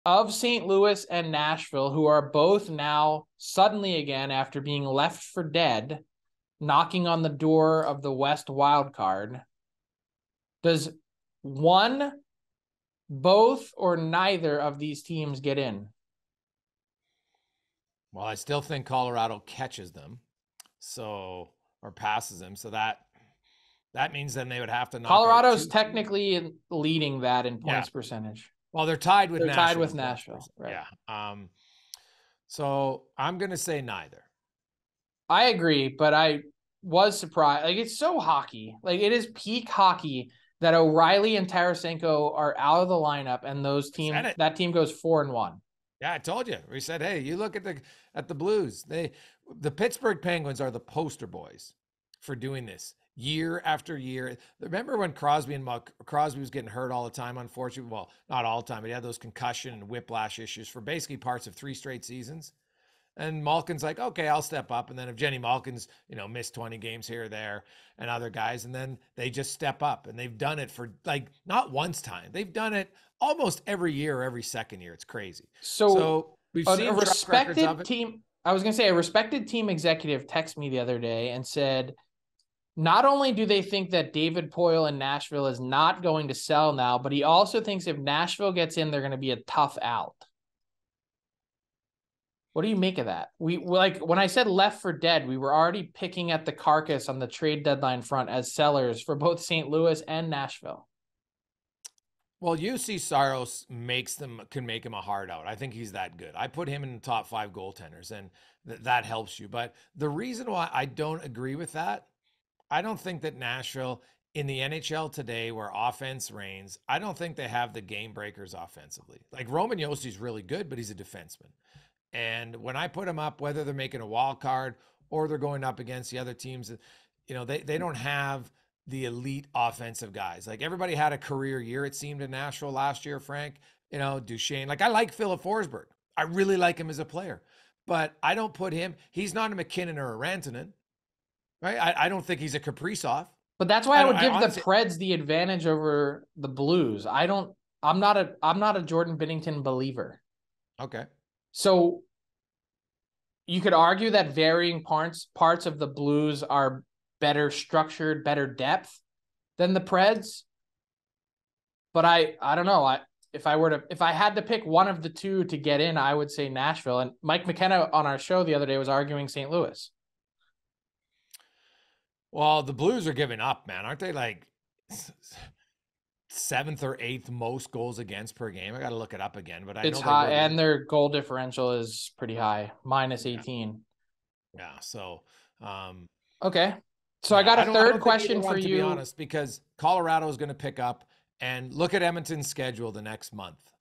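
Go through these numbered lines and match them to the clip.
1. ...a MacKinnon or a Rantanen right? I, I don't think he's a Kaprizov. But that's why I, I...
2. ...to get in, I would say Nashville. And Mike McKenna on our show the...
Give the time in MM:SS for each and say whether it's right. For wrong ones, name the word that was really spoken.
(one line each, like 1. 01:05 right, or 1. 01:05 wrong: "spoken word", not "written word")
1. 02:19 right
2. 02:45 right.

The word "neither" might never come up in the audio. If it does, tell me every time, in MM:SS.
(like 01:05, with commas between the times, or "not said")
00:13, 00:33.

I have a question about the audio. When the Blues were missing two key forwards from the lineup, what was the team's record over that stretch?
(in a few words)
4-1.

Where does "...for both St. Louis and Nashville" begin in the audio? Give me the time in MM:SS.
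01:39.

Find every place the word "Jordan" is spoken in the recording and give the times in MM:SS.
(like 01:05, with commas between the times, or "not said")
02:28.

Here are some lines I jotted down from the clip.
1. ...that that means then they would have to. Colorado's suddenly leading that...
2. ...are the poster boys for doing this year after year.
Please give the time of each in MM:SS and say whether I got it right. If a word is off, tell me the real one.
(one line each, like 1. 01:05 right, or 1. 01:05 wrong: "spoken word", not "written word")
1. 00:22 wrong: "technically", not "suddenly"
2. 00:50 right.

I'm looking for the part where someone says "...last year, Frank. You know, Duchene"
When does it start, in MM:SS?
02:12.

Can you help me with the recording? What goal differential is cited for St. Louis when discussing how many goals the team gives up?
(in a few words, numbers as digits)
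-18.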